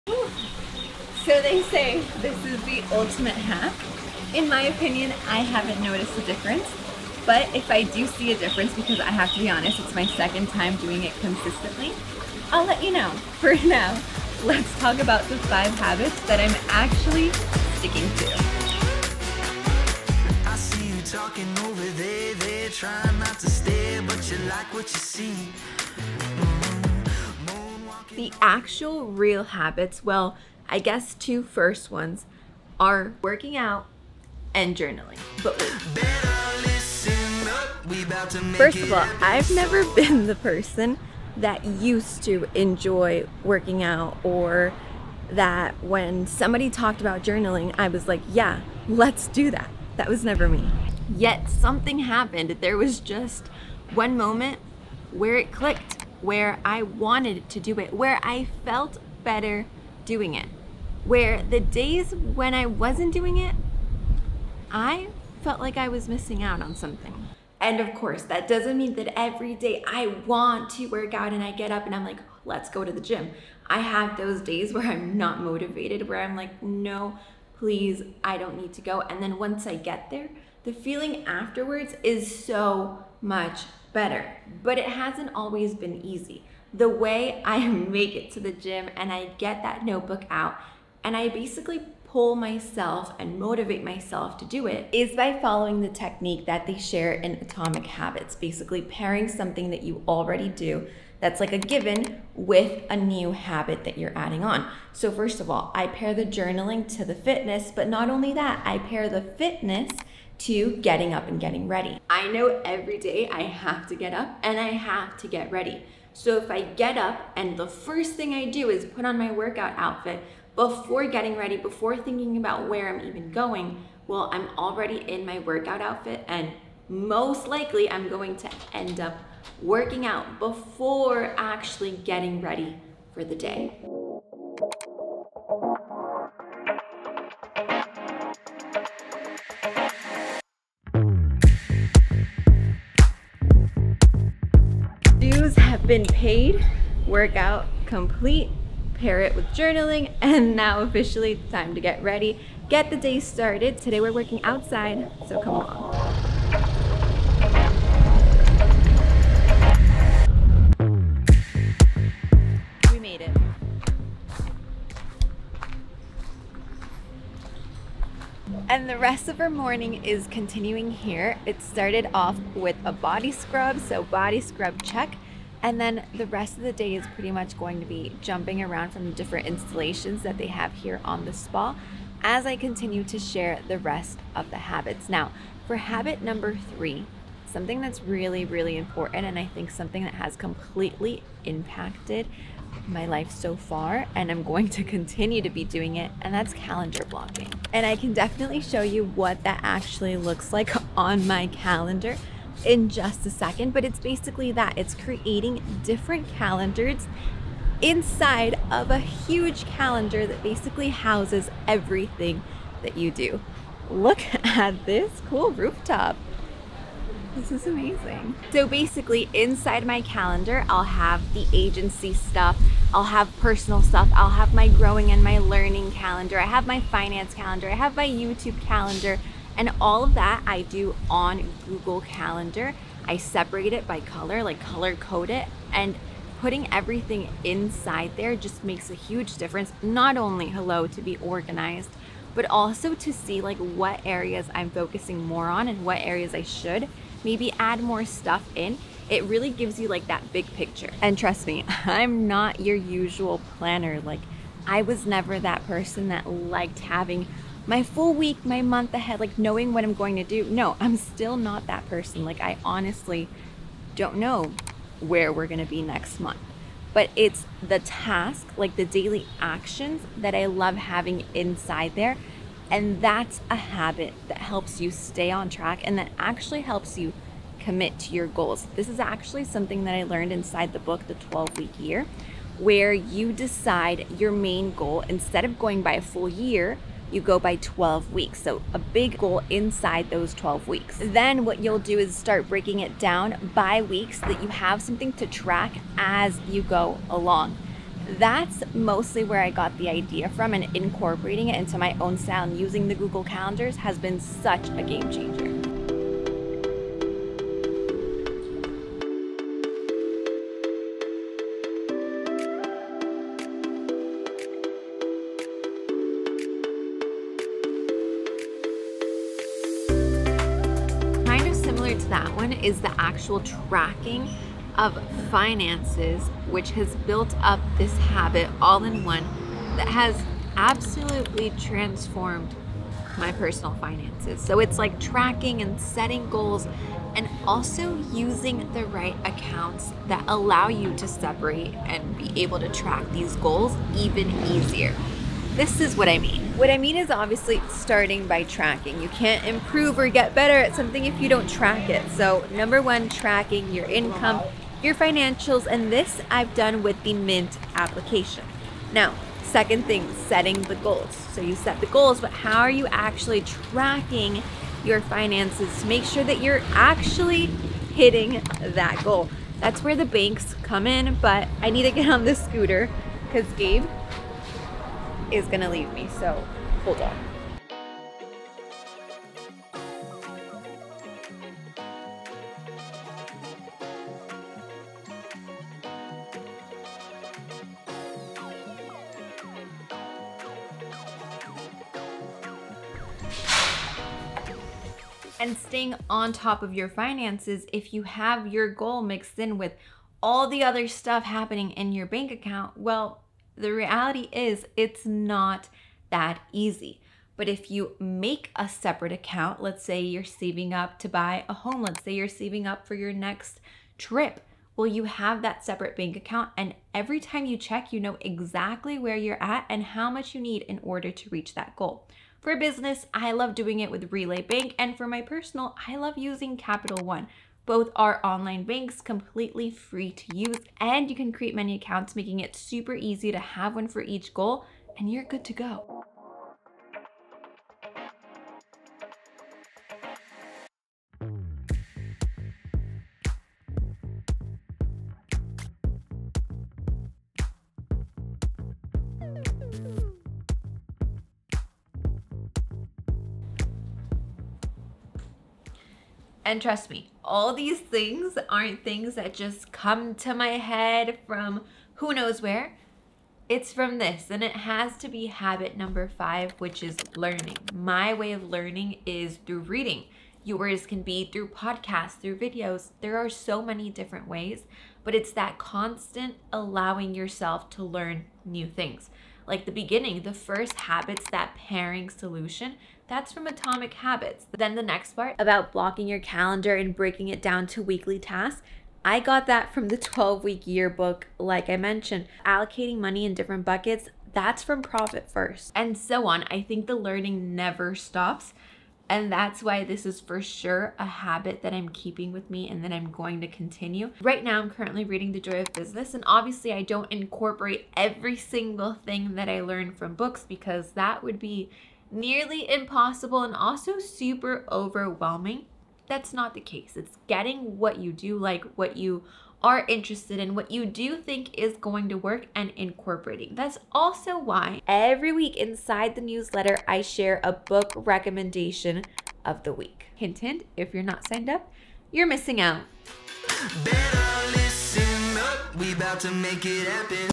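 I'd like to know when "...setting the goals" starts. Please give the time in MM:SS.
06:00.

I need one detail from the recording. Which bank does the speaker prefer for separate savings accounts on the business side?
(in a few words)
Relay Bank.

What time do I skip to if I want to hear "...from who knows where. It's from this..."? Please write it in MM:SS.
07:41.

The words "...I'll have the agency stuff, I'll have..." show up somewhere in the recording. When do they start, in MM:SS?
03:40.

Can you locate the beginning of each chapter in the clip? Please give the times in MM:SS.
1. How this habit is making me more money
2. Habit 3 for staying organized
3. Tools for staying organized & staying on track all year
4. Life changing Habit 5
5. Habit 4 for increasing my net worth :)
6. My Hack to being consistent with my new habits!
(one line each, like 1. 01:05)
1. 05:46
2. 02:14
3. 03:17
4. 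07:16
5. 05:09
6. 01:07.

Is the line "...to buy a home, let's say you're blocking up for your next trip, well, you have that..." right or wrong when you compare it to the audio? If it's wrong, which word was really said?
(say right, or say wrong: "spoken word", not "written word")
wrong: "saving", not "blocking".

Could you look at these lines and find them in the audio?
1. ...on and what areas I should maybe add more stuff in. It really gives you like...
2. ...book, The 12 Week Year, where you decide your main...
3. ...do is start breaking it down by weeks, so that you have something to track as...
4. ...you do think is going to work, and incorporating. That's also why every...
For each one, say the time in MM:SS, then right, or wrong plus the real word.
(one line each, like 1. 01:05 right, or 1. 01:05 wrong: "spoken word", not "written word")
1. 04:05 right
2. 04:40 right
3. 04:51 right
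4. 08:40 right.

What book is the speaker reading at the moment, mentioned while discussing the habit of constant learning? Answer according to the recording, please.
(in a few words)
The Joy of Business.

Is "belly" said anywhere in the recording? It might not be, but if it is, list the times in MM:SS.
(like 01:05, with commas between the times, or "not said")
not said.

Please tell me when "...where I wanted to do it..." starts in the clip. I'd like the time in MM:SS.
00:56.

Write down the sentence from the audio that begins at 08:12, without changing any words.
Allocating money in different buckets, that's from Profit First.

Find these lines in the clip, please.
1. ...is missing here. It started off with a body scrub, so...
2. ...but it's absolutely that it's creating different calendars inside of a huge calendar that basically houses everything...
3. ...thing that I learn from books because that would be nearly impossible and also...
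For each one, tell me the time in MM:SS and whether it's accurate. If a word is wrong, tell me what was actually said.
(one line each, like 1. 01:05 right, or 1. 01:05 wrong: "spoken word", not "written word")
1. 02:50 wrong: "continuing", not "missing"
2. 03:23 wrong: "basically", not "absolutely"
3. 08:28 right.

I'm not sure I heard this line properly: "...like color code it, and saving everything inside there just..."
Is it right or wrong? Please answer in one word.
wrong.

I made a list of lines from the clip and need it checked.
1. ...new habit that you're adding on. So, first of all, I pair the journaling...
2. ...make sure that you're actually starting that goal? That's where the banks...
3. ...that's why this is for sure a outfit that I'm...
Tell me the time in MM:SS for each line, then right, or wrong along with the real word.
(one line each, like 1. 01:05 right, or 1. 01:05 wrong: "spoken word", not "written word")
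1. 01:42 right
2. 06:05 wrong: "hitting", not "starting"
3. 08:19 wrong: "habit", not "outfit".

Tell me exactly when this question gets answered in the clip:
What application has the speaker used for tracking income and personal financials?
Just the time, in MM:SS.
05:57.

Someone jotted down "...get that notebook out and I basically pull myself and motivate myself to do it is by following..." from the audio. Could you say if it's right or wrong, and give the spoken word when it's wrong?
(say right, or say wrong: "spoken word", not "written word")
right.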